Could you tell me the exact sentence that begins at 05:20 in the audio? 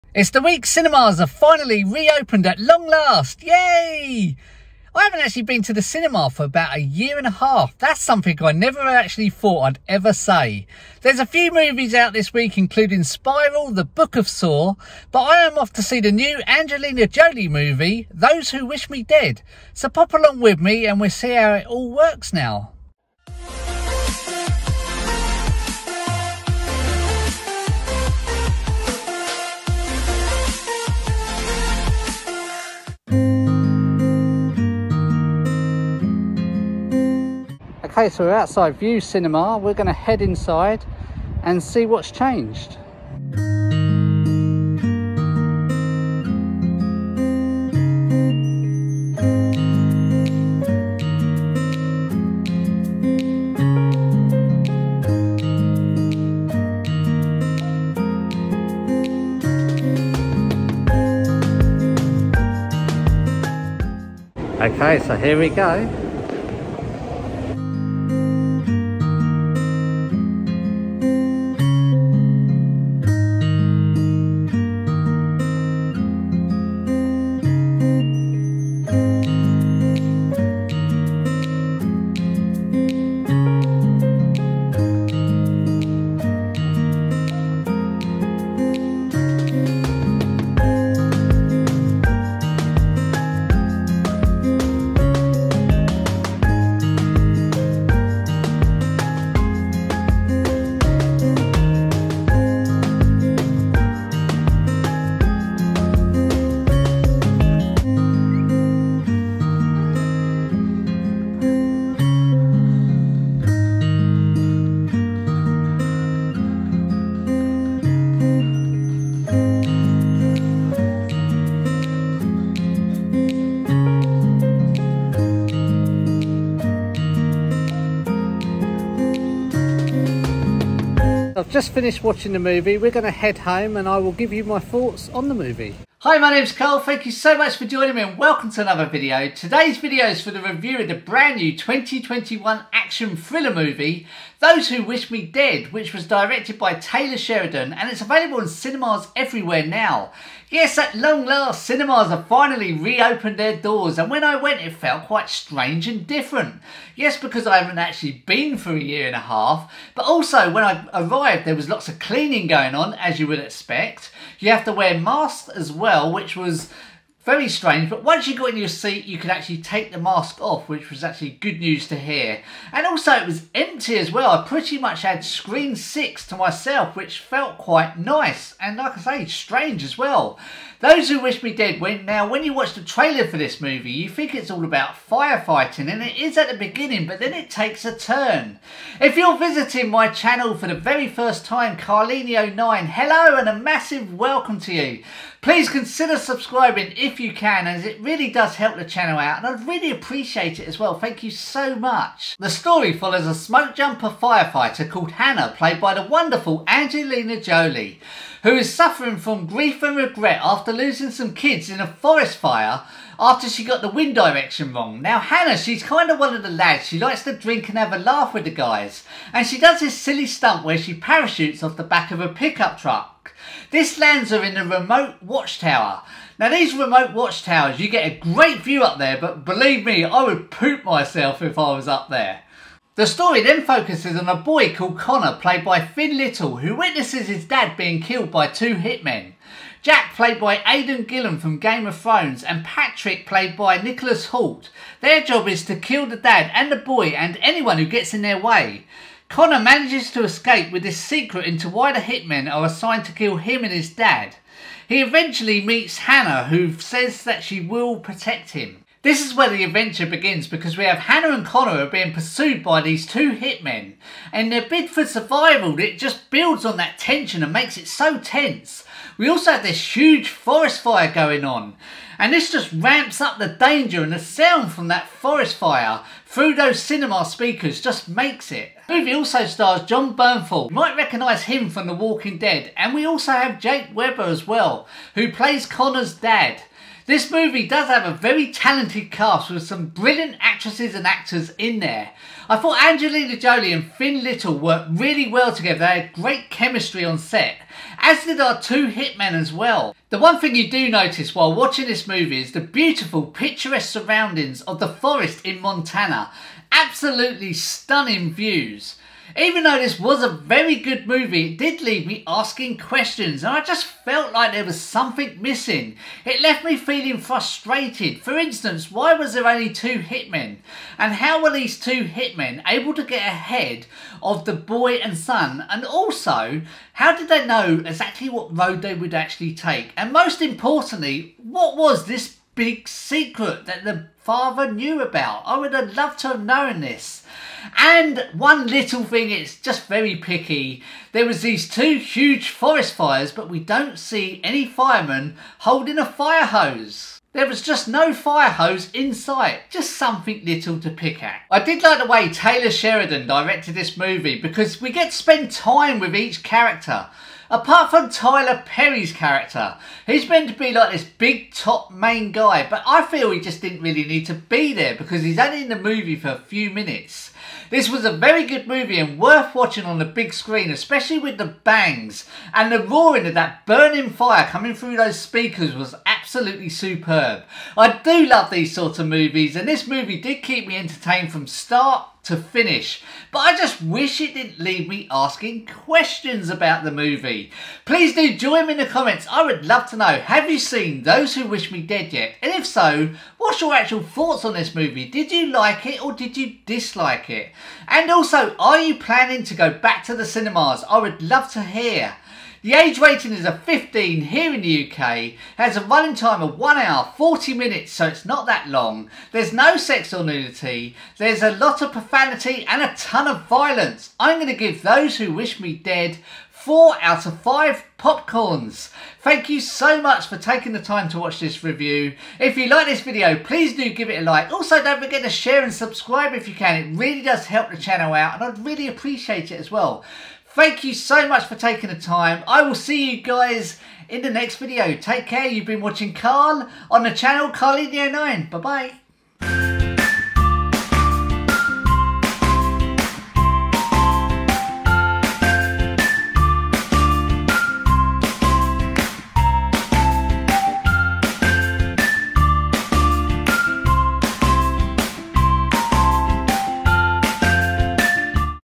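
And how were these two hitmen able to get ahead of the boy and son?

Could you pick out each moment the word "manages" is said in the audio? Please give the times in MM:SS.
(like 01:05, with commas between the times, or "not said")
04:09.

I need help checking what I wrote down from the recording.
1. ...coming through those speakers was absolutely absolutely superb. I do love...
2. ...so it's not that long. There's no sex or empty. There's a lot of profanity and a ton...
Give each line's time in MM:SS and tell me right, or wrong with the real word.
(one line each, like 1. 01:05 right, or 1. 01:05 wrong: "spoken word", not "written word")
1. 06:14 right
2. 06:47 wrong: "nudity", not "empty".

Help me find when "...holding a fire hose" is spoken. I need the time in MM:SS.
05:45.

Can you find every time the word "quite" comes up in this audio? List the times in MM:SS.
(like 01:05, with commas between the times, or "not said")
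02:35, 02:57.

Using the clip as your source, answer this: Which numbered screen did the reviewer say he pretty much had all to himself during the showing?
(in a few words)
6.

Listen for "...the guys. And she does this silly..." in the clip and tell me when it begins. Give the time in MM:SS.
03:38.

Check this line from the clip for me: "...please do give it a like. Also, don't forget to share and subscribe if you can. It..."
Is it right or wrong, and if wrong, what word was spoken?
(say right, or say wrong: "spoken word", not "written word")
right.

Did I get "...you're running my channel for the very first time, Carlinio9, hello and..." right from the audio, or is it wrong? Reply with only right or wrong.
wrong.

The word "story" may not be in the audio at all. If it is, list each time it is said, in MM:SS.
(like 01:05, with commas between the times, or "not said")
03:22, 03:53.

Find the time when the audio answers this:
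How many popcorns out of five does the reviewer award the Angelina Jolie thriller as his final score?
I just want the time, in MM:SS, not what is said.
06:56.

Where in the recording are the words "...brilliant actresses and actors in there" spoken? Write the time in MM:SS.
04:49.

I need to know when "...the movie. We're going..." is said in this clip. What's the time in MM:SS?
02:12.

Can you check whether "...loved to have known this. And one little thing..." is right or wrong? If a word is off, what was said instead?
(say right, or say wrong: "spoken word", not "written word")
right.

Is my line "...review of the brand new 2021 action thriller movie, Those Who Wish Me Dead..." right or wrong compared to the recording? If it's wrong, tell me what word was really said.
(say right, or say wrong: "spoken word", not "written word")
right.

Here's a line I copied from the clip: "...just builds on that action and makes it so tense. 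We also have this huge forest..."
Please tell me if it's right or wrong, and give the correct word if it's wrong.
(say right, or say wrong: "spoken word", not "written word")
wrong: "tension", not "action".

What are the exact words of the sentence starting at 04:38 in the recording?
The movie also stars Jon Bernthal.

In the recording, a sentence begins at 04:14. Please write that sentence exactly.
He eventually meets Hannah, who says that she will protect him.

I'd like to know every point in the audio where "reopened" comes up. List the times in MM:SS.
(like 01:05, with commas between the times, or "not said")
00:01, 02:32.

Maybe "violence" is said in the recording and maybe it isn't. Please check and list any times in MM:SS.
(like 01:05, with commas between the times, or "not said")
06:53.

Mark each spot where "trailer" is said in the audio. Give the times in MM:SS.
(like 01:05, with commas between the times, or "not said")
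03:02.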